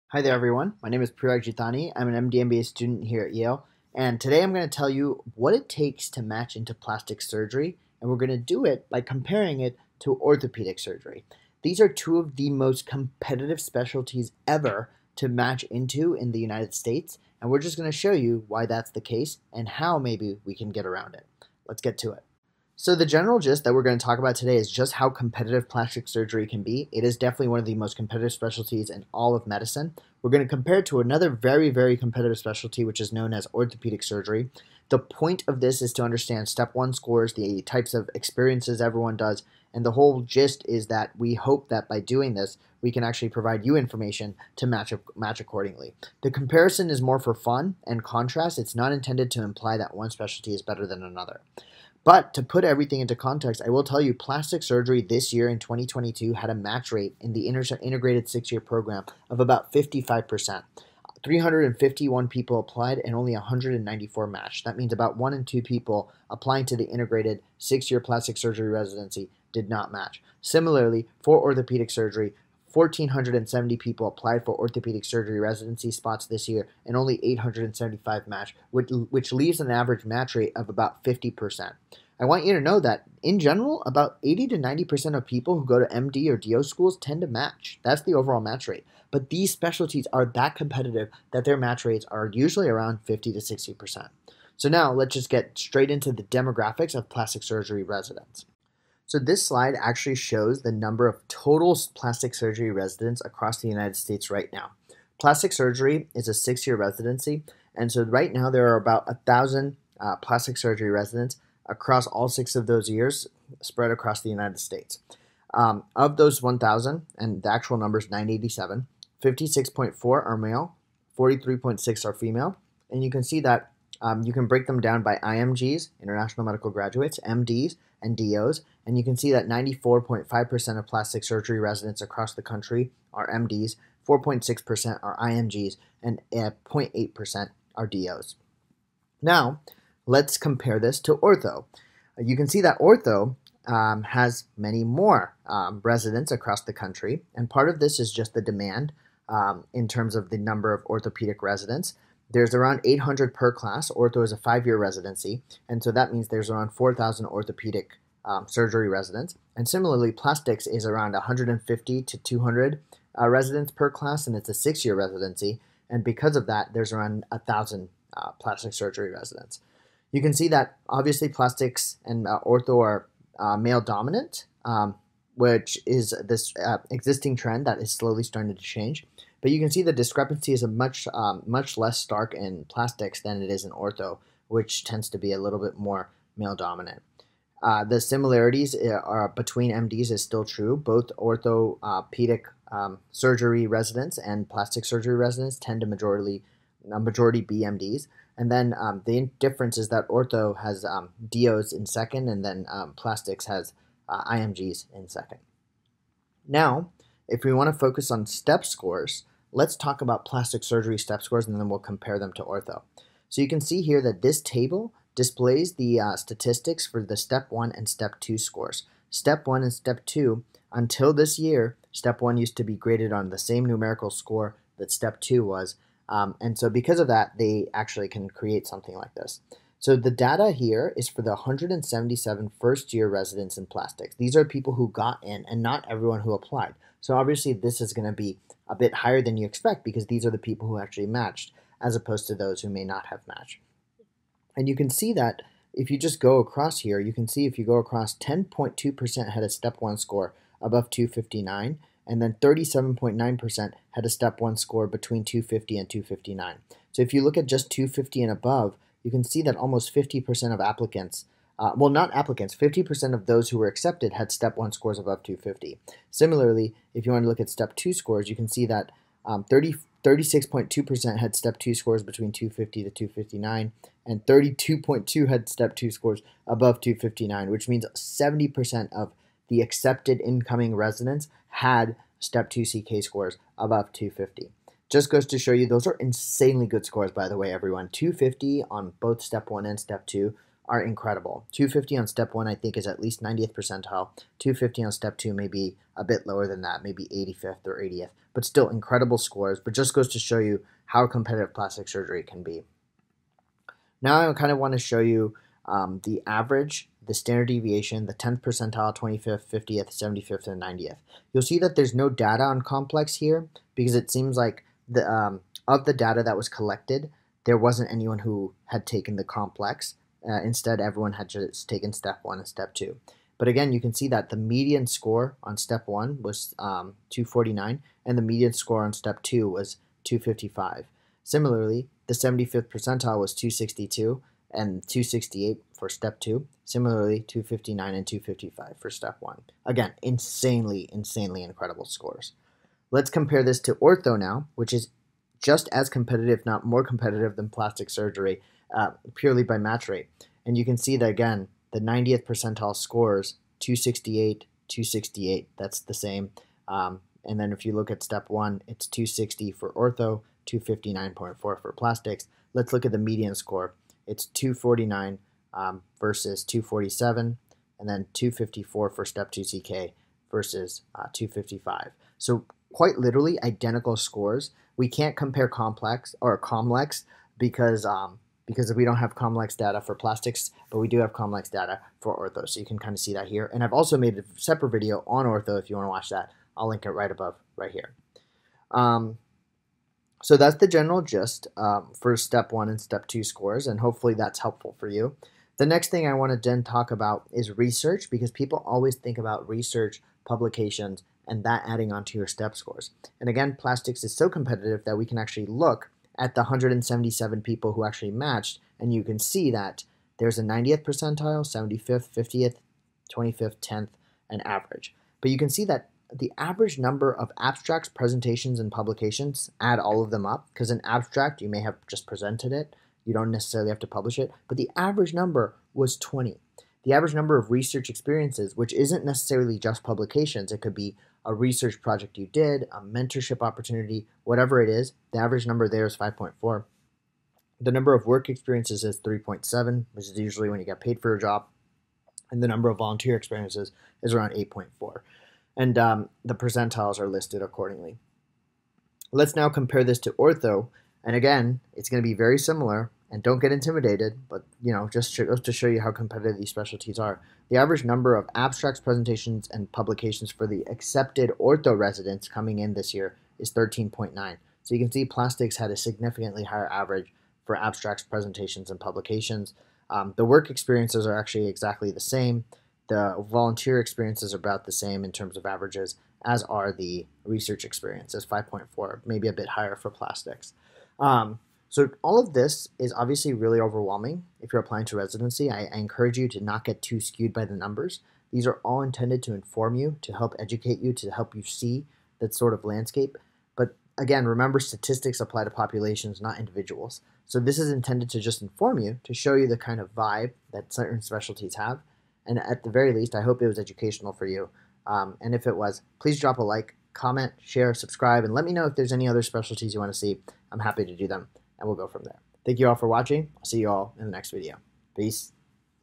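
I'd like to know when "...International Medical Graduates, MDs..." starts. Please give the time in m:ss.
2:06.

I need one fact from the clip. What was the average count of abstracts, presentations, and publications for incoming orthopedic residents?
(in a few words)
13.9.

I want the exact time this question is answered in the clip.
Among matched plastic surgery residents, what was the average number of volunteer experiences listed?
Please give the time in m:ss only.
7:24.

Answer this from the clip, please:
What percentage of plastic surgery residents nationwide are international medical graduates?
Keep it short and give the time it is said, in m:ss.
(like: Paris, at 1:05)
4.6%, at 2:14.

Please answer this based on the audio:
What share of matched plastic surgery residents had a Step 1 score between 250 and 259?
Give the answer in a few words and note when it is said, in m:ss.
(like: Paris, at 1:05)
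37.9%, at 4:12.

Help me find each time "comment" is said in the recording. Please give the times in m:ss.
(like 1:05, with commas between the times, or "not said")
8:26.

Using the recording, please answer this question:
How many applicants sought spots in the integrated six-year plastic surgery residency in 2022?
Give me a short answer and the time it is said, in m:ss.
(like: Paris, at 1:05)
351, at 1:01.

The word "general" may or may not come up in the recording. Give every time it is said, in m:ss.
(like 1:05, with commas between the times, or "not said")
0:23, 1:23, 6:30.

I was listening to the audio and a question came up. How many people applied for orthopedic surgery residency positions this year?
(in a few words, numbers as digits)
1,470.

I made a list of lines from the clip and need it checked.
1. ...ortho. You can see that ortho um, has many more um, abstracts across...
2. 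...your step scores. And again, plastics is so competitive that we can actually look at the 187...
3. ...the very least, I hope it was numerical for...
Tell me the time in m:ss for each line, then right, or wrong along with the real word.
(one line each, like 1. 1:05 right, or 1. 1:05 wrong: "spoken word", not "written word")
1. 2:21 wrong: "residents", not "abstracts"
2. 6:42 wrong: "177", not "187"
3. 8:22 wrong: "educational", not "numerical".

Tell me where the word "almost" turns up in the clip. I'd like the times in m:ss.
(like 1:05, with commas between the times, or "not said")
4:19.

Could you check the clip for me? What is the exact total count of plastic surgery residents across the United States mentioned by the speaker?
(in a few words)
987.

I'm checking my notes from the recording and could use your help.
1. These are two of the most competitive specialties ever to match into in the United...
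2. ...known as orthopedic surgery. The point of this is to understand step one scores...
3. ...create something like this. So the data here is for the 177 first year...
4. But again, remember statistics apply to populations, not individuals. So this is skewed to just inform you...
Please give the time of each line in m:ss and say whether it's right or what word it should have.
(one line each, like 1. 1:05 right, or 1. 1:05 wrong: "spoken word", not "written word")
1. 0:11 right
2. 0:33 right
3. 3:48 right
4. 8:13 wrong: "intended", not "skewed".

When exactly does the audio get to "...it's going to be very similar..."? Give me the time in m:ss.
7:31.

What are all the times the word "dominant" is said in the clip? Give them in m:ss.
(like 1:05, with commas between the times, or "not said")
2:53, 3:06.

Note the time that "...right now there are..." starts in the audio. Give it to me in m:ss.
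1:48.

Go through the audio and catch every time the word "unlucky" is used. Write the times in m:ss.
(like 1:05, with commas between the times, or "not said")
not said.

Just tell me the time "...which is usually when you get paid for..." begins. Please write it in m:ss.
7:19.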